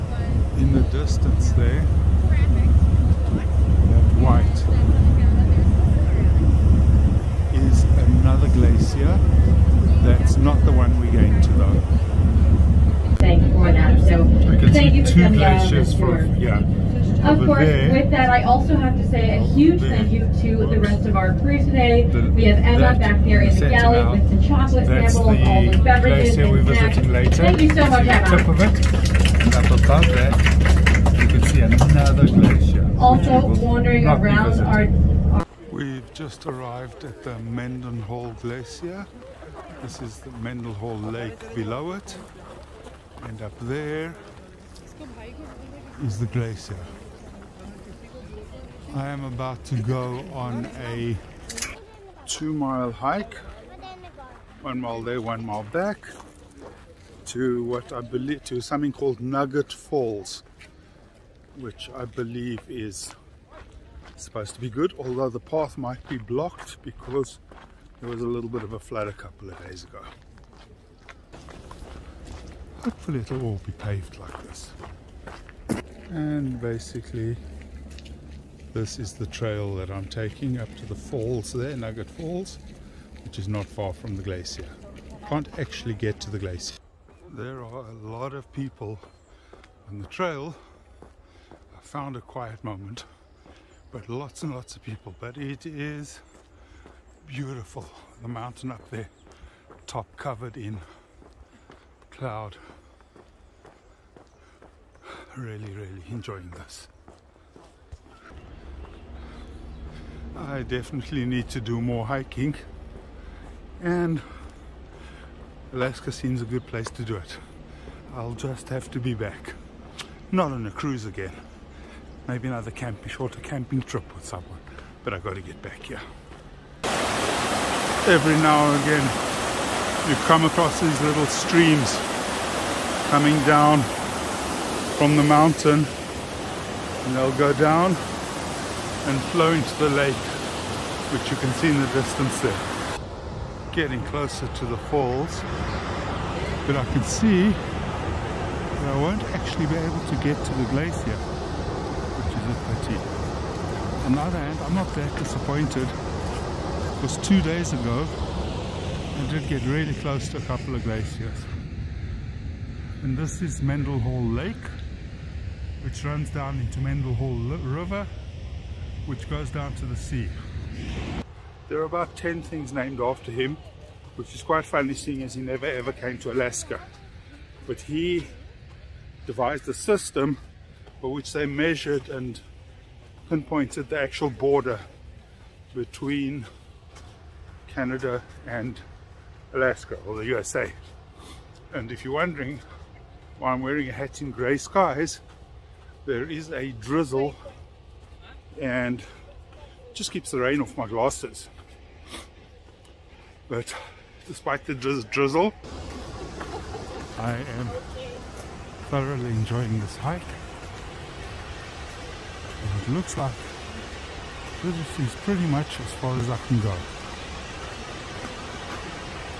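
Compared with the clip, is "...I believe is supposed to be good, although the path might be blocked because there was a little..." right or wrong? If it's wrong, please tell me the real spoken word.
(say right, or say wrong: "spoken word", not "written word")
right.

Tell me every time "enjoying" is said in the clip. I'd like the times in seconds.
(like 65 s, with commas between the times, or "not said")
106 s, 209 s.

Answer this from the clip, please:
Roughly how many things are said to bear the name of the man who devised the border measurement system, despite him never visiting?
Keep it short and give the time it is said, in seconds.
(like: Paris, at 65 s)
10, at 172 s.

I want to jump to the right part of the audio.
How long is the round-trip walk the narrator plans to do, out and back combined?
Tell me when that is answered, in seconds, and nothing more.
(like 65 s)
52 s.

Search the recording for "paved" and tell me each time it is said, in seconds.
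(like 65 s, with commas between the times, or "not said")
73 s.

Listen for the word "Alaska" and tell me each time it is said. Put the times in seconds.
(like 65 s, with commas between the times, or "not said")
115 s, 176 s, 189 s.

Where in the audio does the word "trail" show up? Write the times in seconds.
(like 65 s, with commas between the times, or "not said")
79 s, 90 s.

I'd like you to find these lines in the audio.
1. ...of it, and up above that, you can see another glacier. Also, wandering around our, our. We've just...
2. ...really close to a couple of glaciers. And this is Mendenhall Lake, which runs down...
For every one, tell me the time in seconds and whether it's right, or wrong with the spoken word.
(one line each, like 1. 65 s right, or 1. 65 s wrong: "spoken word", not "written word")
1. 28 s right
2. 159 s right.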